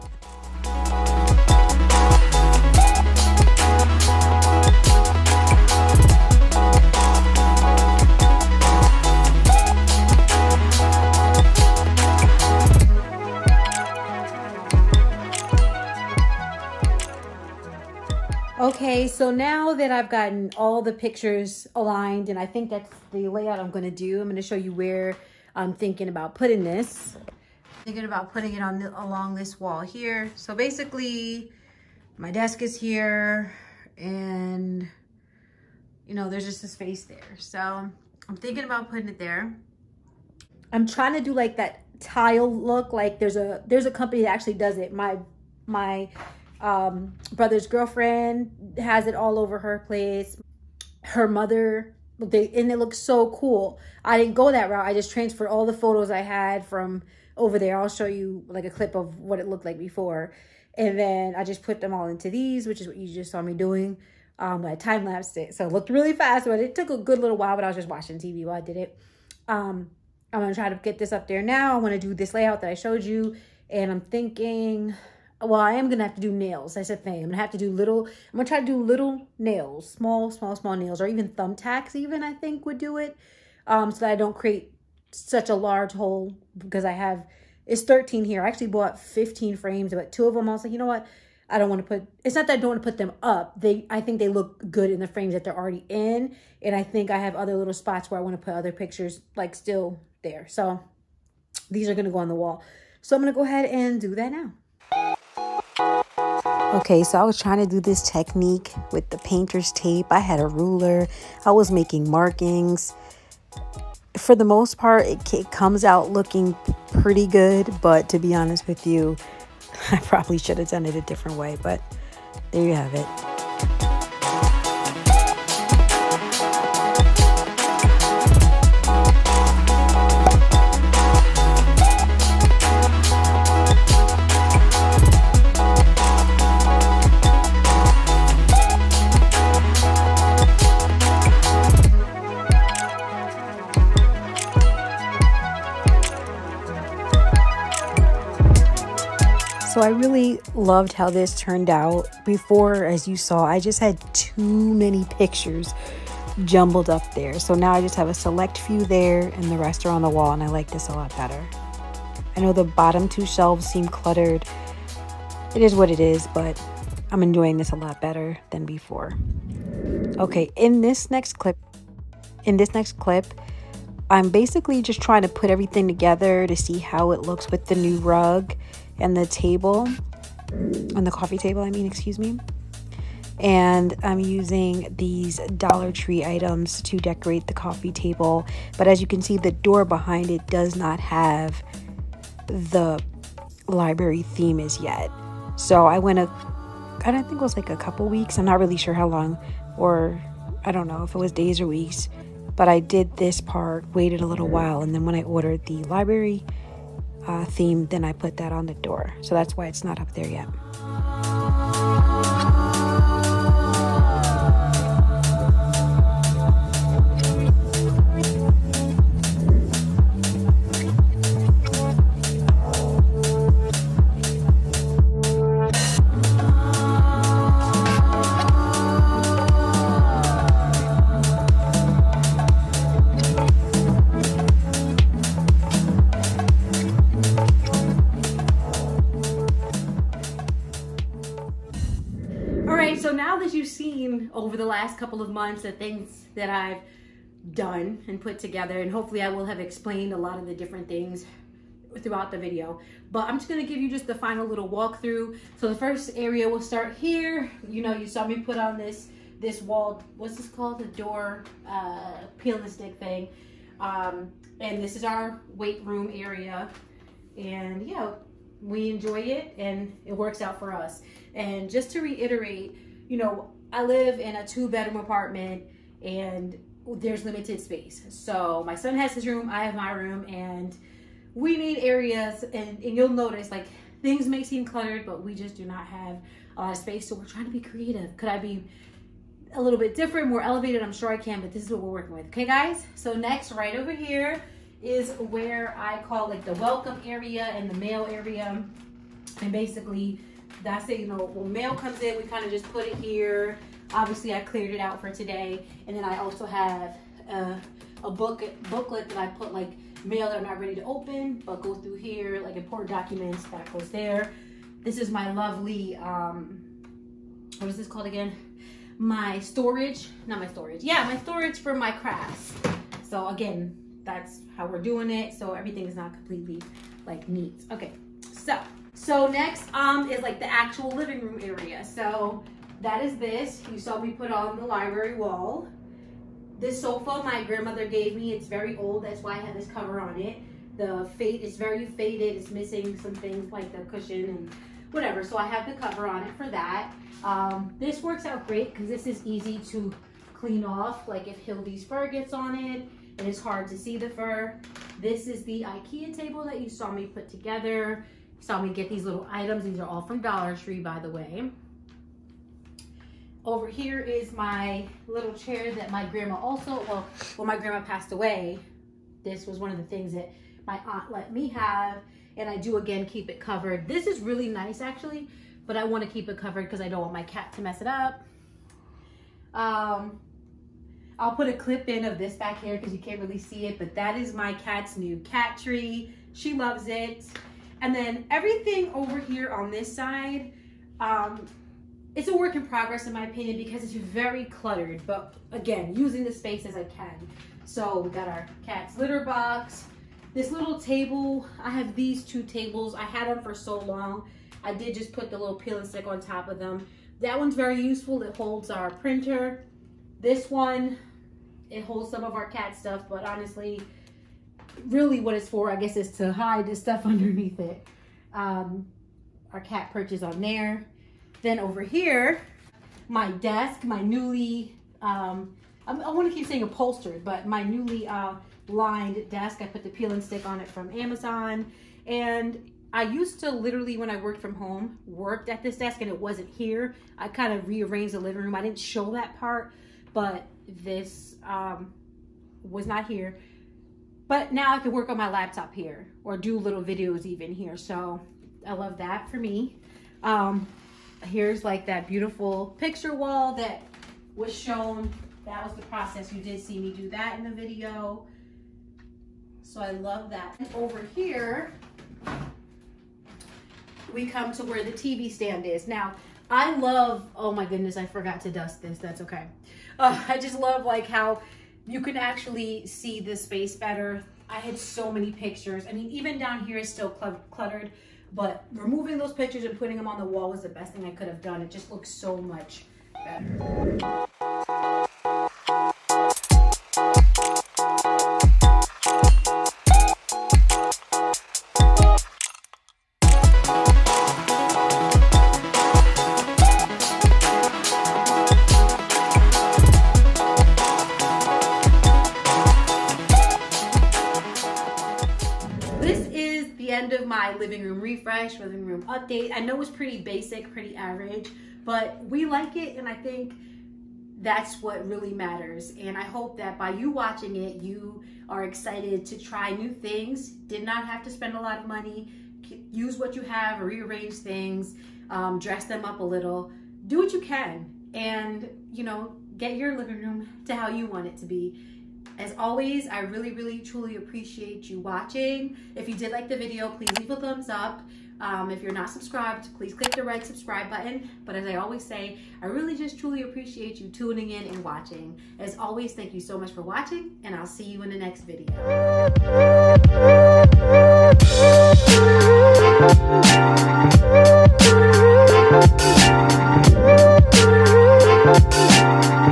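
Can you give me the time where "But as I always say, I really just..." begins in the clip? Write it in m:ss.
9:01.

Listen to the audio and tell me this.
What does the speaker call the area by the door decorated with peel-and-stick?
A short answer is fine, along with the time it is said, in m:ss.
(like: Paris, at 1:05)
Weight room, at 4:25.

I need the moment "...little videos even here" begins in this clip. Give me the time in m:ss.
7:26.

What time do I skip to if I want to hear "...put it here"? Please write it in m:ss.
5:02.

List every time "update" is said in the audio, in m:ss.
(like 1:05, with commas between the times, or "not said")
8:29.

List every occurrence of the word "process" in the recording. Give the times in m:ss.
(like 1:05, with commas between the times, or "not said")
7:35.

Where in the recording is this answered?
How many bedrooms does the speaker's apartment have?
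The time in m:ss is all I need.
4:34.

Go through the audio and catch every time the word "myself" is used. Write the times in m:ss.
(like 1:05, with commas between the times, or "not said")
not said.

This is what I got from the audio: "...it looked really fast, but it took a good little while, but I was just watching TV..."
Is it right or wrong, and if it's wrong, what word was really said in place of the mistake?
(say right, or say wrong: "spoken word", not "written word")
right.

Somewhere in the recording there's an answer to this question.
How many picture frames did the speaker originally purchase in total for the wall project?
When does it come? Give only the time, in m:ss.
1:28.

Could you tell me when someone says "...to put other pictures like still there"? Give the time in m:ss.
1:38.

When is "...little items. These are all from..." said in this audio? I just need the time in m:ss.
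5:59.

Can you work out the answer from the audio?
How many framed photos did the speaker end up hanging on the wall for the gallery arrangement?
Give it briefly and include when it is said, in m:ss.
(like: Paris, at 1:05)
13, at 1:27.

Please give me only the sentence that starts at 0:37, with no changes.
So I'm thinking about putting it there.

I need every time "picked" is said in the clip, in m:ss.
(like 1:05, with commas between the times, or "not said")
not said.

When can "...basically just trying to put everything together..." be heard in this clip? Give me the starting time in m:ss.
2:54.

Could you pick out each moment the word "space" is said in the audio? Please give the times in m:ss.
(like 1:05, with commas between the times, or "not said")
0:36, 4:37, 4:46, 6:36, 7:53.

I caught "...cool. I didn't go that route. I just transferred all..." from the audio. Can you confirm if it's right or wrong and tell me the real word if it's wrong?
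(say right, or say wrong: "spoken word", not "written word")
right.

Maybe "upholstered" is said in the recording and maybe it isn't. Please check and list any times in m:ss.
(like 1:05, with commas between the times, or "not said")
7:06.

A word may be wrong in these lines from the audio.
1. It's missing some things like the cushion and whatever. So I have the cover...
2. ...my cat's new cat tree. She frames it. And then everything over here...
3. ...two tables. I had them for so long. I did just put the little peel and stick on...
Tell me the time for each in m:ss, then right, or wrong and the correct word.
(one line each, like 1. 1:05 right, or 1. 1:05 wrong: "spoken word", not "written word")
1. 5:42 right
2. 6:24 wrong: "loves", not "frames"
3. 6:42 right.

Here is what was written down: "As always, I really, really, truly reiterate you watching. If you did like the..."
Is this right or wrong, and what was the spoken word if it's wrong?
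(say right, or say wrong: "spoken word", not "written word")
wrong: "appreciate", not "reiterate".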